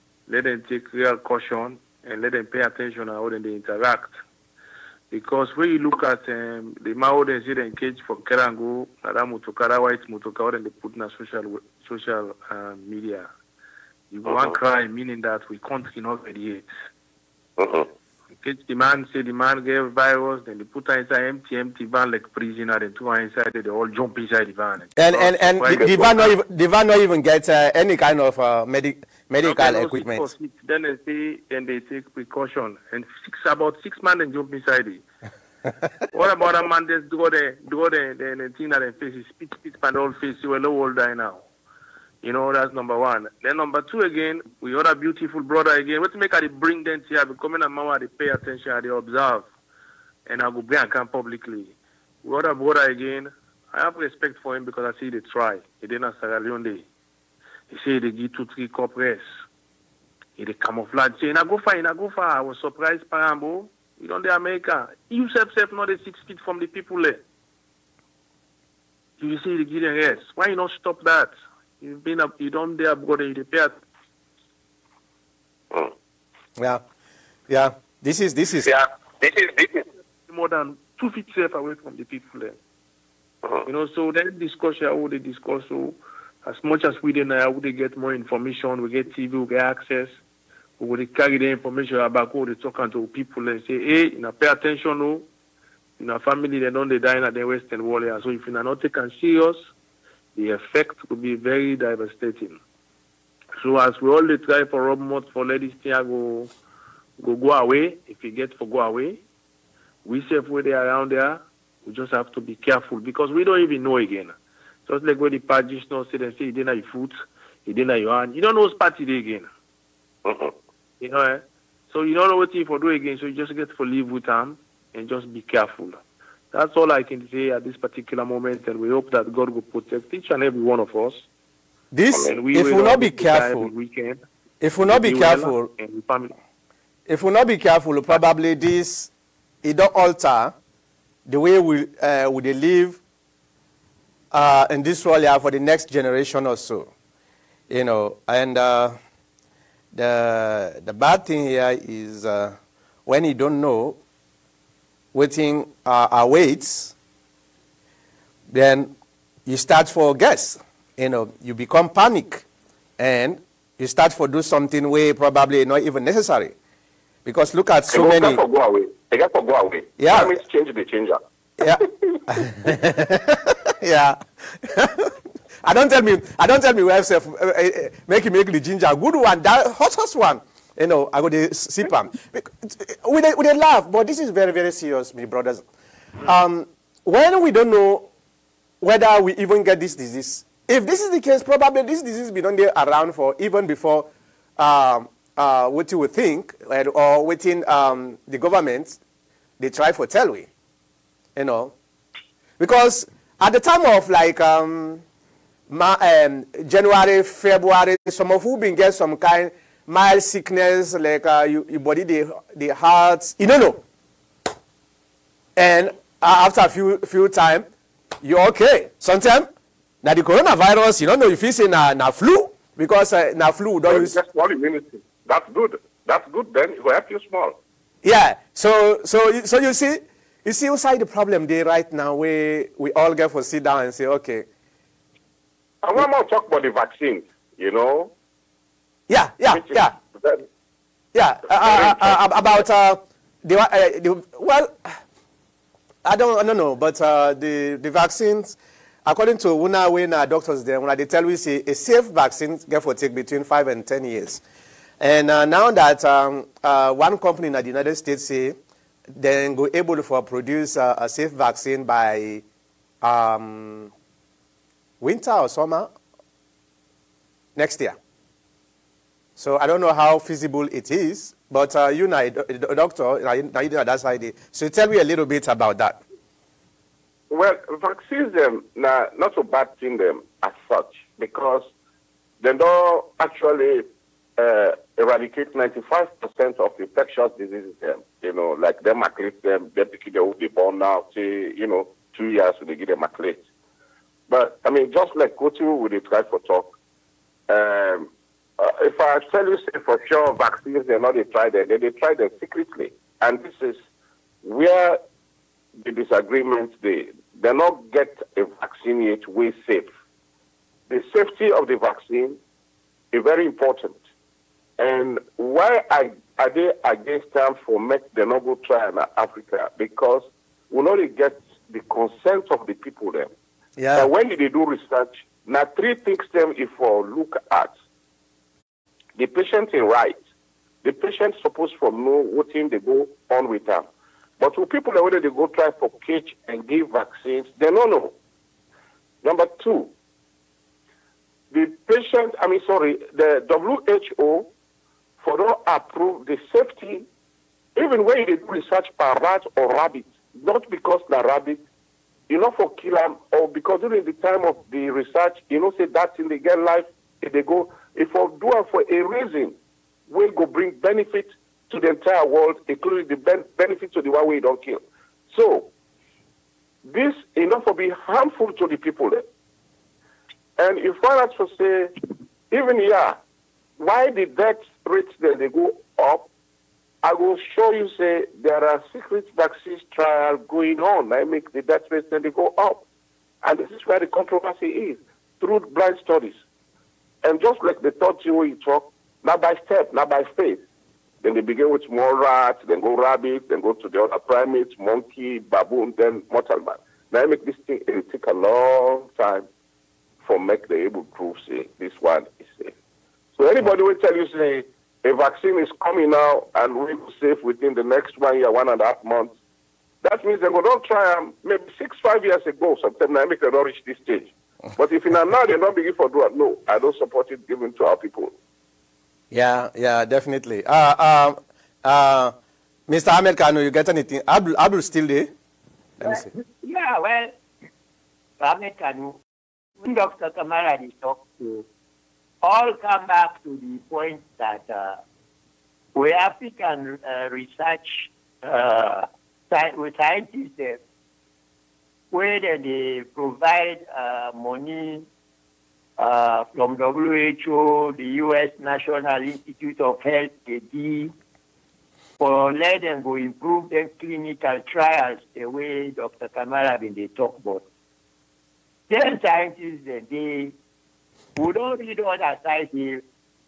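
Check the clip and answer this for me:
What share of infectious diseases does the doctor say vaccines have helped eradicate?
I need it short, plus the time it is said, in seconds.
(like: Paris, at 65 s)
95%, at 285 s.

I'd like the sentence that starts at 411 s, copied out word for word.
Um, maybe six, five years ago, sometimes I make them not reach this stage.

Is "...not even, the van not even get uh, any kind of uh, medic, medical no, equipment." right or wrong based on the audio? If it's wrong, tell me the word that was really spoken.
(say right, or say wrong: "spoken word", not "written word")
right.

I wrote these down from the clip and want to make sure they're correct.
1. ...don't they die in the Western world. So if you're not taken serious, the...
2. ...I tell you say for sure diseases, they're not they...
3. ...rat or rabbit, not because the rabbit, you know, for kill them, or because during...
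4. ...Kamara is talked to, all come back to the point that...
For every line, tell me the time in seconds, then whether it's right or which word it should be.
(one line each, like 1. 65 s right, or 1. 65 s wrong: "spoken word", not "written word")
1. 96 s right
2. 298 s wrong: "vaccines", not "diseases"
3. 349 s right
4. 430 s right.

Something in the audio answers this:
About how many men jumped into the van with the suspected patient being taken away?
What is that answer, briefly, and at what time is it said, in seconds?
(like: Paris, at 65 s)
6, at 33 s.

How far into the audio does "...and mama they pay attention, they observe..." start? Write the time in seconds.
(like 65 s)
47 s.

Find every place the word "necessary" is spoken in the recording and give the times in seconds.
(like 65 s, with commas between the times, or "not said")
166 s.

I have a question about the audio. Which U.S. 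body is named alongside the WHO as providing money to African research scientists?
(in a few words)
National Institute of Health.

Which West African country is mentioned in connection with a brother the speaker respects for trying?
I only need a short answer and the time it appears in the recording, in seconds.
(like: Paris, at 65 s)
Sierra Leone, at 56 s.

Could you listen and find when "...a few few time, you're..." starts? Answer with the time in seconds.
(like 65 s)
216 s.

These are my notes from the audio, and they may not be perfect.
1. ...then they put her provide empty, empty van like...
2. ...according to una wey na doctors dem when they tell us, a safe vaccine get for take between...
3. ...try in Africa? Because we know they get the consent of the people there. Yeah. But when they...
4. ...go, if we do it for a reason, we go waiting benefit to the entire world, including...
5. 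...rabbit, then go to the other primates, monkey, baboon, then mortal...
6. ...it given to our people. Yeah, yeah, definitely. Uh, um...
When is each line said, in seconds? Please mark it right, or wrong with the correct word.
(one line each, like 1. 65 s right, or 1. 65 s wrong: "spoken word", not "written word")
1. 20 s wrong: "inside", not "provide"
2. 249 s right
3. 318 s right
4. 357 s wrong: "bring", not "waiting"
5. 392 s right
6. 417 s right.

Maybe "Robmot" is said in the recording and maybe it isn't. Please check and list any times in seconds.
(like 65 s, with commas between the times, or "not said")
104 s.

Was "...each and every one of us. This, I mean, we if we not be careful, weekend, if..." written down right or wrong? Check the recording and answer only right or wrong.
right.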